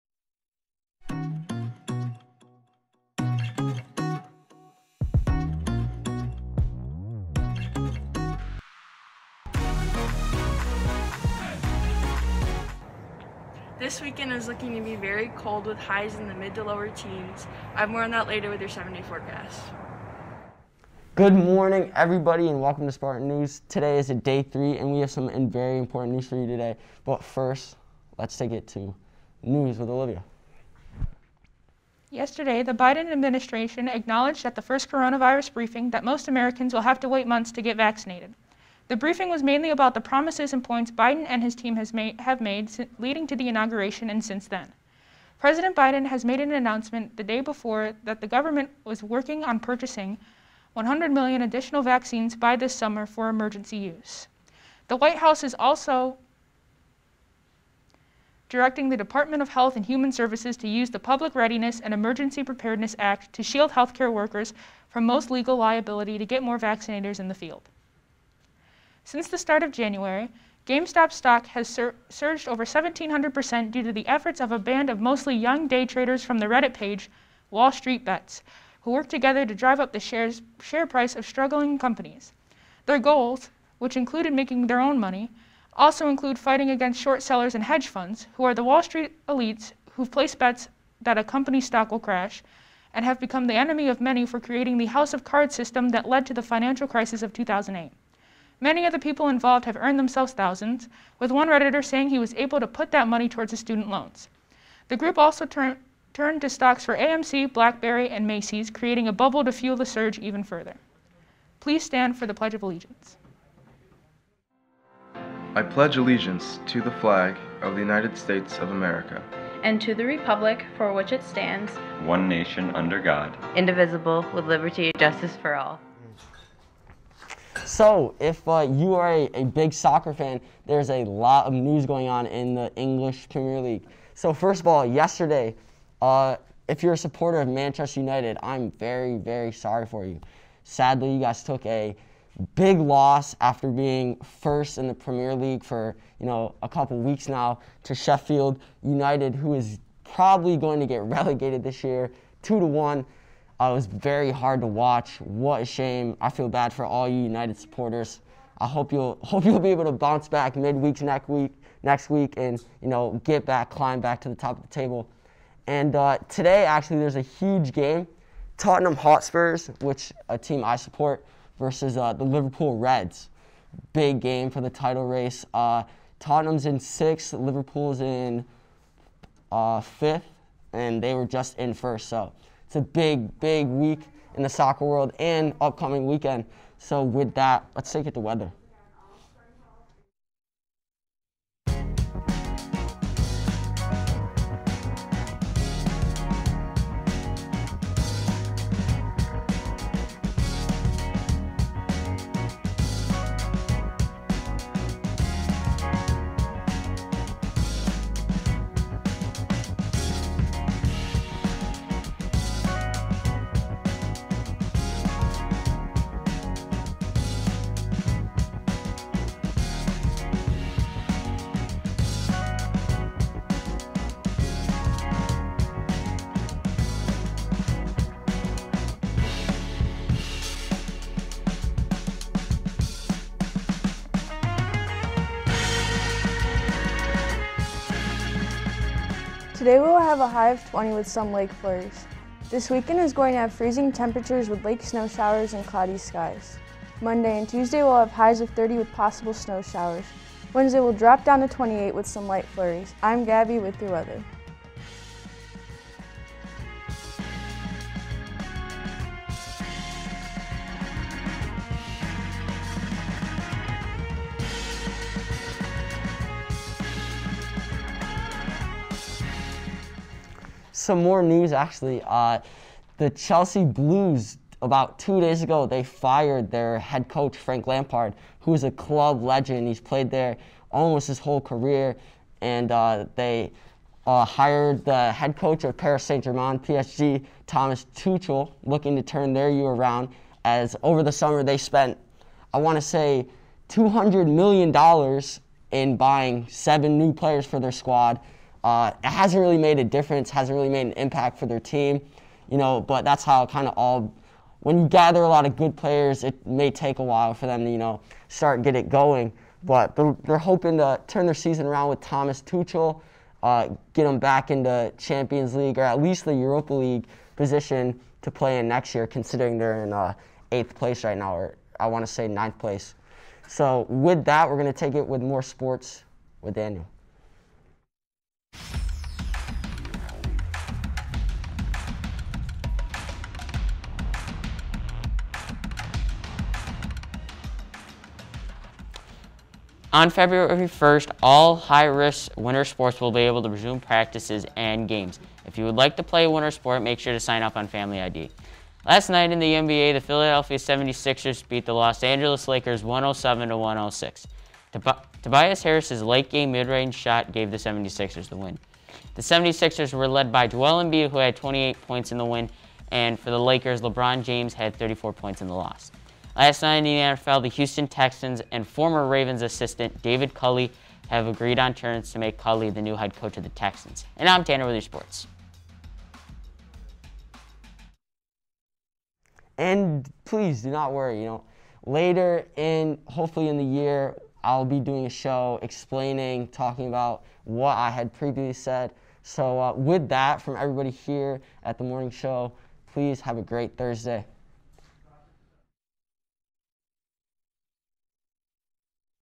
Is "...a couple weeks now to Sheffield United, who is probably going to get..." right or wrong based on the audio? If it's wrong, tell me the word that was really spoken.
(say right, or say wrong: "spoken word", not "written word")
right.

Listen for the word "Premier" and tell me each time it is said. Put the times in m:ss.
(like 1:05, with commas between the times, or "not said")
2:13, 2:24.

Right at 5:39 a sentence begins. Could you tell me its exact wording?
On February 1st, all high-risk winter sports will be able to resume practices and games.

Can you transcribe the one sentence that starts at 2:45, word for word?
And uh, today actually there's a huge game, Tottenham Hotspurs, which a team I support, versus uh, the Liverpool Reds.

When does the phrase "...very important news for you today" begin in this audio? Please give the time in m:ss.
0:25.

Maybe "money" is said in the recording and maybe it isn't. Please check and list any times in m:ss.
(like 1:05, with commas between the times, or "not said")
1:24, 1:43.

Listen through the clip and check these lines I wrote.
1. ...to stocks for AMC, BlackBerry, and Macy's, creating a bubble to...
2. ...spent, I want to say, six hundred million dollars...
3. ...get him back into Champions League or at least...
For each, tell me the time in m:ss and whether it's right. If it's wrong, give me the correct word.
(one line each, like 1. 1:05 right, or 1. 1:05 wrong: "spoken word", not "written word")
1. 1:46 right
2. 4:51 wrong: "two", not "six"
3. 5:13 right.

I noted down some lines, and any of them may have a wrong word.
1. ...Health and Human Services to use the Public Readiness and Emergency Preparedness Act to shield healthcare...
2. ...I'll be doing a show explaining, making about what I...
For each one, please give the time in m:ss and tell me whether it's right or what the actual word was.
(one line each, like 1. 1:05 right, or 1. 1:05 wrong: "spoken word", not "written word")
1. 0:59 right
2. 6:24 wrong: "talking", not "making".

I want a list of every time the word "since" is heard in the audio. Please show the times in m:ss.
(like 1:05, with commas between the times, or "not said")
0:44, 1:09.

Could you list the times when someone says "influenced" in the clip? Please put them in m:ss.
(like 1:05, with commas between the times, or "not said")
not said.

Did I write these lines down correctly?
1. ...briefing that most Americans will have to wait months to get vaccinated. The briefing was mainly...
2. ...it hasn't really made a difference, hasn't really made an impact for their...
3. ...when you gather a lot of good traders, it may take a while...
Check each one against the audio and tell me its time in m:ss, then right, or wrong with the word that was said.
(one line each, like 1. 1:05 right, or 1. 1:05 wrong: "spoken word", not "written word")
1. 0:35 right
2. 4:59 right
3. 5:04 wrong: "players", not "traders".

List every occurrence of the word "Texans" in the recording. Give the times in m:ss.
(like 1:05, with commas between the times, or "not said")
6:07, 6:13.